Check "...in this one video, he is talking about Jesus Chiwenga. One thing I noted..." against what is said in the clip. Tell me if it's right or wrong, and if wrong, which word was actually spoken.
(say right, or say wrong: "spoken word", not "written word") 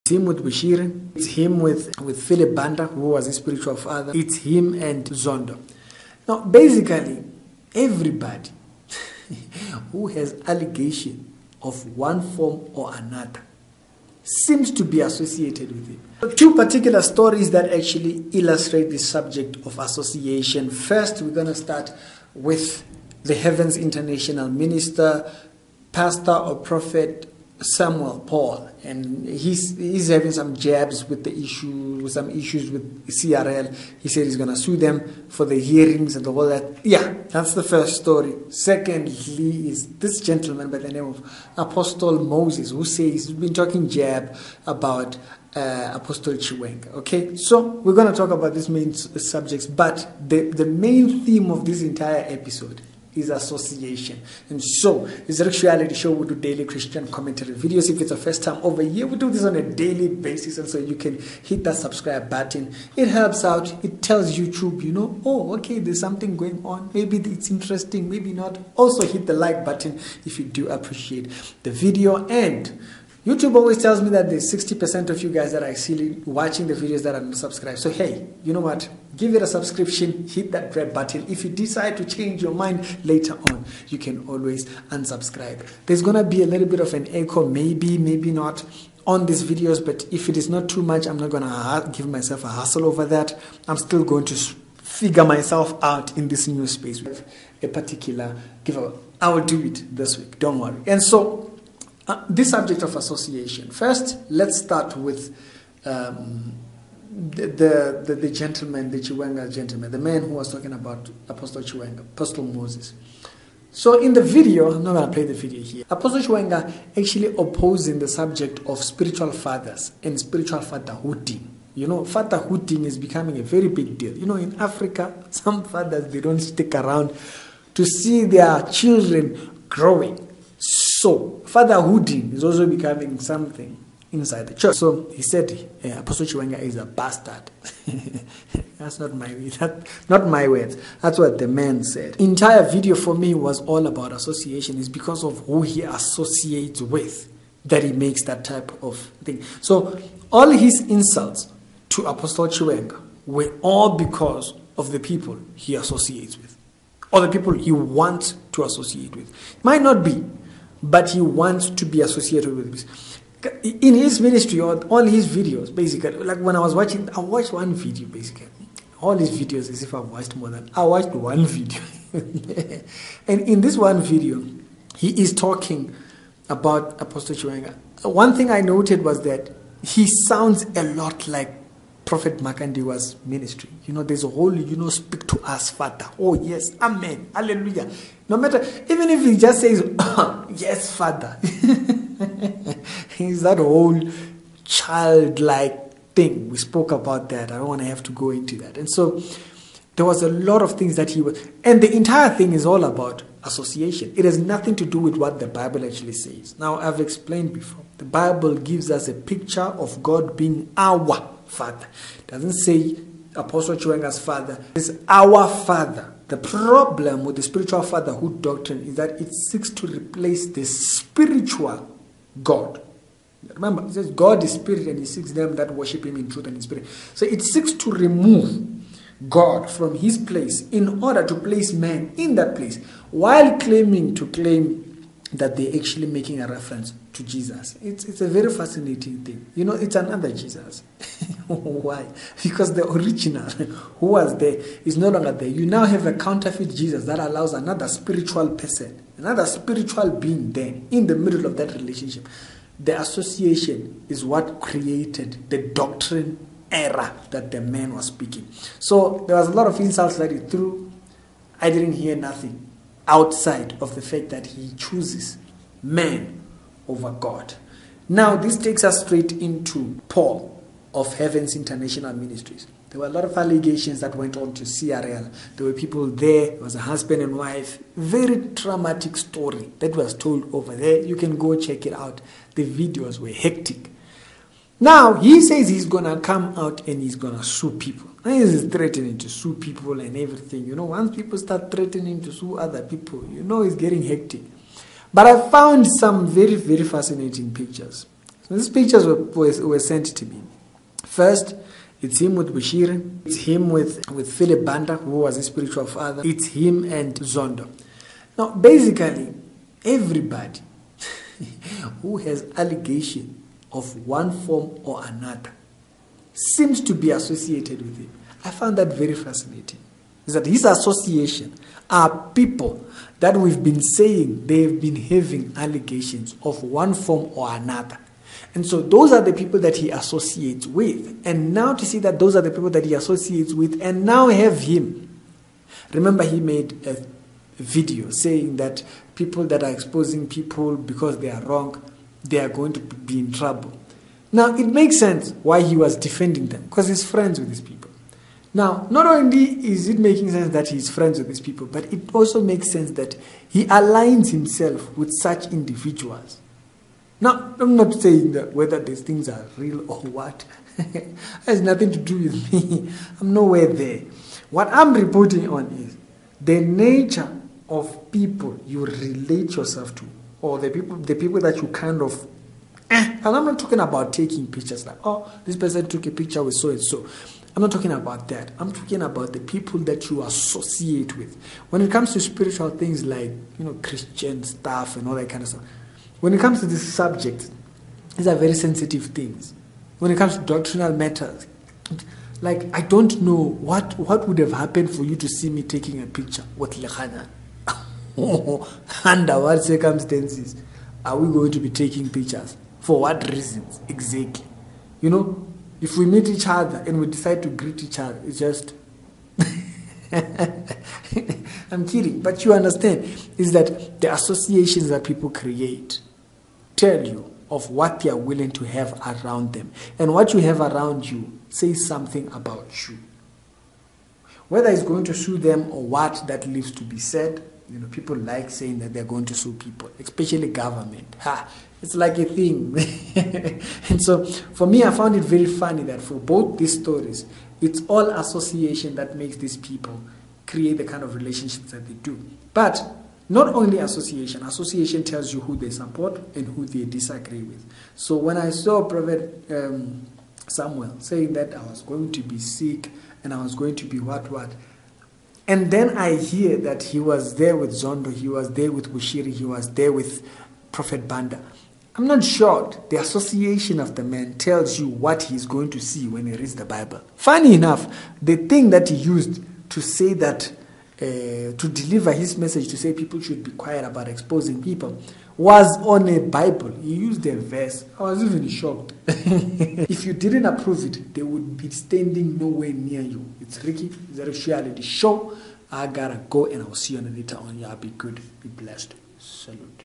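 wrong: "Apostle", not "Jesus".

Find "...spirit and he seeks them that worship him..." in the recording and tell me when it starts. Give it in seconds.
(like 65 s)
224 s.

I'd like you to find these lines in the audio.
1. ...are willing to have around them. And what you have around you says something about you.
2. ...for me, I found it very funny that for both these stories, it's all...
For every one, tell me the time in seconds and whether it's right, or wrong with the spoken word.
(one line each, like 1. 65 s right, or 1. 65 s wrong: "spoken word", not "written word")
1. 418 s right
2. 434 s right.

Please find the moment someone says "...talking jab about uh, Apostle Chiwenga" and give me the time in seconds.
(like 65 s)
43 s.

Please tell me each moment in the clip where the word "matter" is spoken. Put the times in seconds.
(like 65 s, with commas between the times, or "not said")
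188 s, 390 s.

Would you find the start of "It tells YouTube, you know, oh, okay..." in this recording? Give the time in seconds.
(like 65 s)
63 s.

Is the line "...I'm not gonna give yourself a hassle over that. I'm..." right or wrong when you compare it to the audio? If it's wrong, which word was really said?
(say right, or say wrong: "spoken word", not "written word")
wrong: "myself", not "yourself".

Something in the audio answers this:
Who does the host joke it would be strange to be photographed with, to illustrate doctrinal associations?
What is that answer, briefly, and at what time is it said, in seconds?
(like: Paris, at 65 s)
Lehana, at 396 s.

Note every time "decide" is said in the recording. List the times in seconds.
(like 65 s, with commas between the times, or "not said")
81 s, 407 s.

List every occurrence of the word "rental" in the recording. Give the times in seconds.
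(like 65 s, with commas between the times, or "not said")
not said.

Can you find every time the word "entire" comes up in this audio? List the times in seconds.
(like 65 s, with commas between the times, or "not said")
51 s, 142 s, 201 s.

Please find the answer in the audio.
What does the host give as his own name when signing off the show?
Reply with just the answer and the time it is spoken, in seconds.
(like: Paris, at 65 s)
Ricky, at 483 s.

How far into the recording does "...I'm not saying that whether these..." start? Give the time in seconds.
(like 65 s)
357 s.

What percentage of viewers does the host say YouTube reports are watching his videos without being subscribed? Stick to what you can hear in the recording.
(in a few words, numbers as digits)
60%.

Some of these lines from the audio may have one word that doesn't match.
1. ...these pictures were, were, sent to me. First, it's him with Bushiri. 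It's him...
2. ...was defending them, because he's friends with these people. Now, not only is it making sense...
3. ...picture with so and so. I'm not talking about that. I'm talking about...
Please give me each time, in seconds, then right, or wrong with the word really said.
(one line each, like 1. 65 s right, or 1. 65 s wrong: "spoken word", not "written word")
1. 298 s right
2. 345 s right
3. 376 s right.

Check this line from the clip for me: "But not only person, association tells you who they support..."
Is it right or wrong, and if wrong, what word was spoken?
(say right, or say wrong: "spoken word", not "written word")
wrong: "association", not "person".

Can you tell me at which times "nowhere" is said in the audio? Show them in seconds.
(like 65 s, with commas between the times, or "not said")
363 s, 482 s.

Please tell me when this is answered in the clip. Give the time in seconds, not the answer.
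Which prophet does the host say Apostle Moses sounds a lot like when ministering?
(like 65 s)
182 s.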